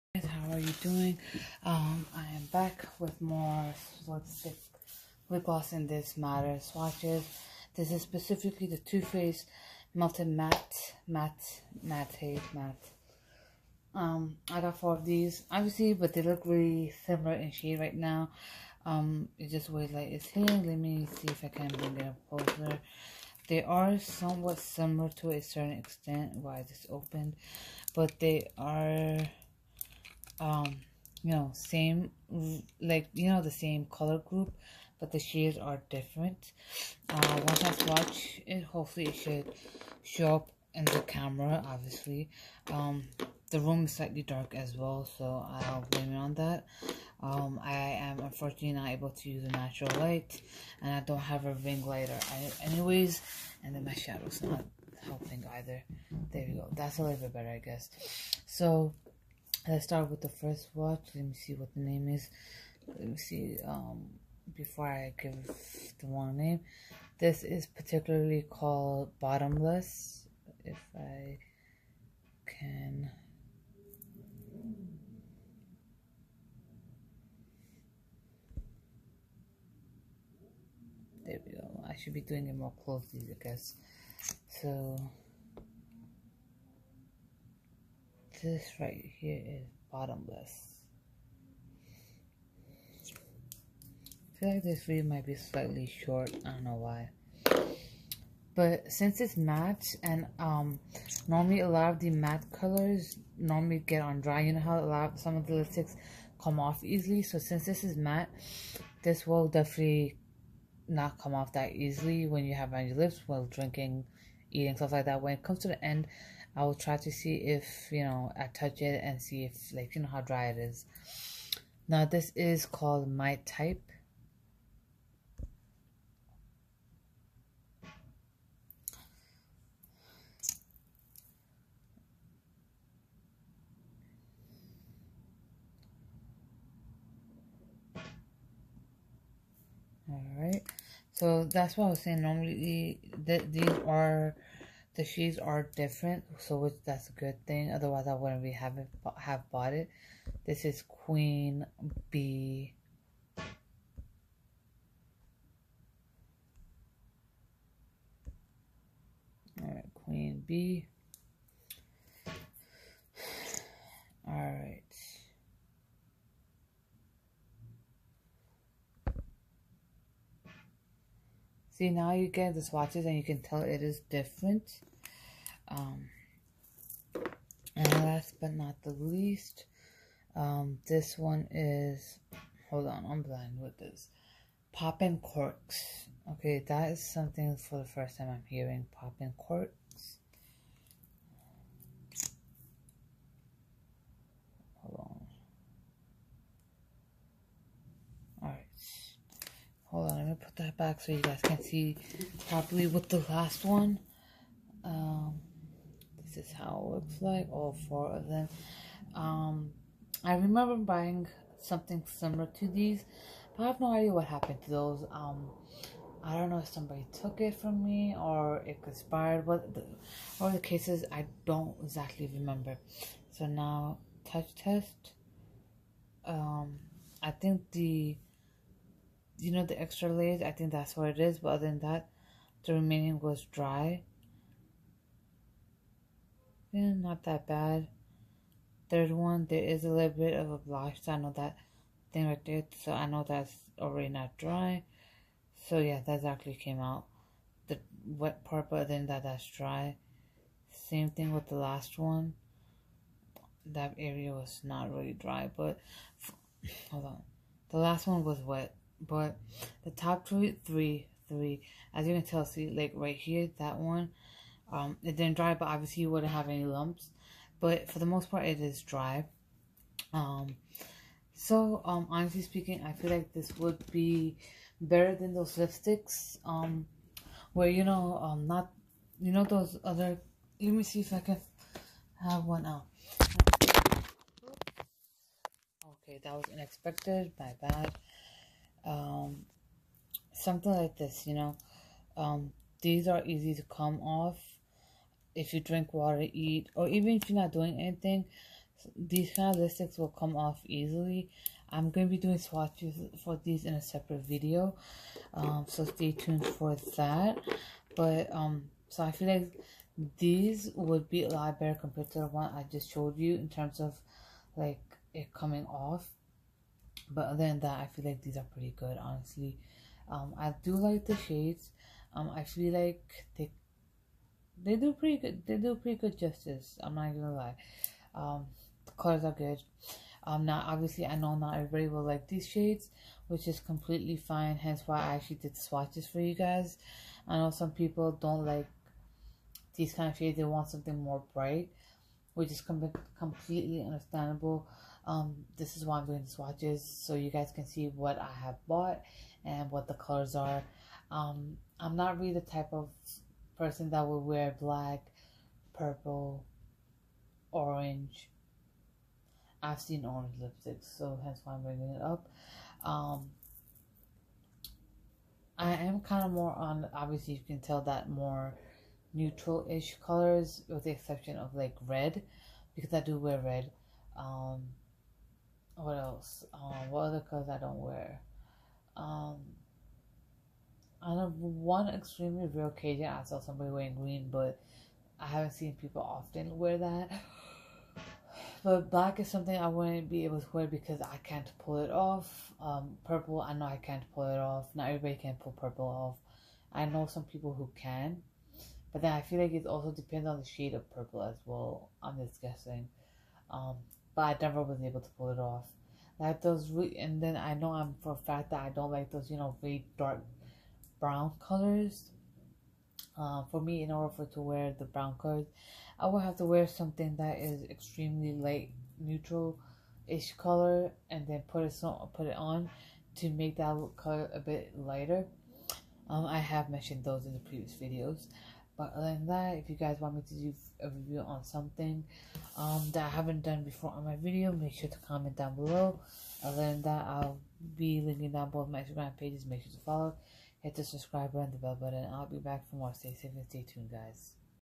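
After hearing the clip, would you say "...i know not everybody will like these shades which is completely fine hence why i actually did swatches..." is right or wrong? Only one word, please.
right.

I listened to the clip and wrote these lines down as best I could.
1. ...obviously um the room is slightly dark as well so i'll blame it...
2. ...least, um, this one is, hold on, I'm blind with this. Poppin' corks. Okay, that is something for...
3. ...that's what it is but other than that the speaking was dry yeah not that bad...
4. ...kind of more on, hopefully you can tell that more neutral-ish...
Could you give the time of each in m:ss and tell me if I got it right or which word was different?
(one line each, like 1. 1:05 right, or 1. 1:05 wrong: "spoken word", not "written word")
1. 0:41 right
2. 2:58 right
3. 3:50 wrong: "remaining", not "speaking"
4. 6:06 wrong: "obviously", not "hopefully".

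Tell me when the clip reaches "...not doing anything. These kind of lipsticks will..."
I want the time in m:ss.
4:57.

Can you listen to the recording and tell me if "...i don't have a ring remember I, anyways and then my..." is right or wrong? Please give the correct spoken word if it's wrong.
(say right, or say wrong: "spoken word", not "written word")
wrong: "lighter", not "remember".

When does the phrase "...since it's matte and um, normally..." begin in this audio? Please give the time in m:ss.
1:38.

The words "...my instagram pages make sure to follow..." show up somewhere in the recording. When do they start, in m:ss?
7:18.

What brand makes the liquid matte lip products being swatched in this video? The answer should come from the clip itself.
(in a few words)
Too Faced.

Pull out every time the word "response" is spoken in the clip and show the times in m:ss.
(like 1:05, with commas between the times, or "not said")
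not said.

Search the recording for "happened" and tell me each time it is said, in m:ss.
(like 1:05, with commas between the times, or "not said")
3:34.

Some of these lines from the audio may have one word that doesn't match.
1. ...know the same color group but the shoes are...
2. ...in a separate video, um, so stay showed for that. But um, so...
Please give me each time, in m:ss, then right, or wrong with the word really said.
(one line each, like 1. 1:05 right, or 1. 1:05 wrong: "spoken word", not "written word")
1. 0:33 wrong: "shades", not "shoes"
2. 5:03 wrong: "tuned", not "showed".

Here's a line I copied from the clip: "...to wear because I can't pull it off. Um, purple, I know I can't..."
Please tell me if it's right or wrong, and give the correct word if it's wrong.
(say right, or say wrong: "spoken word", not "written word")
right.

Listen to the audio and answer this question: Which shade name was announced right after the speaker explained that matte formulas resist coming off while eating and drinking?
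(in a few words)
My Type.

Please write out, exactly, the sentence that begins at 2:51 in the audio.
See, now you get the swatches and you can tell it is different.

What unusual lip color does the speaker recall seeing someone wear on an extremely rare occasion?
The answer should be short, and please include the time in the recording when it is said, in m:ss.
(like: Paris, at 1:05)
Green, at 6:23.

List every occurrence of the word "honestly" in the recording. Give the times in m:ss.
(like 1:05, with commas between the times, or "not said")
4:32, 5:19.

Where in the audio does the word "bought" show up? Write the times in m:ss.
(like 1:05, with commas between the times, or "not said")
2:29, 5:48.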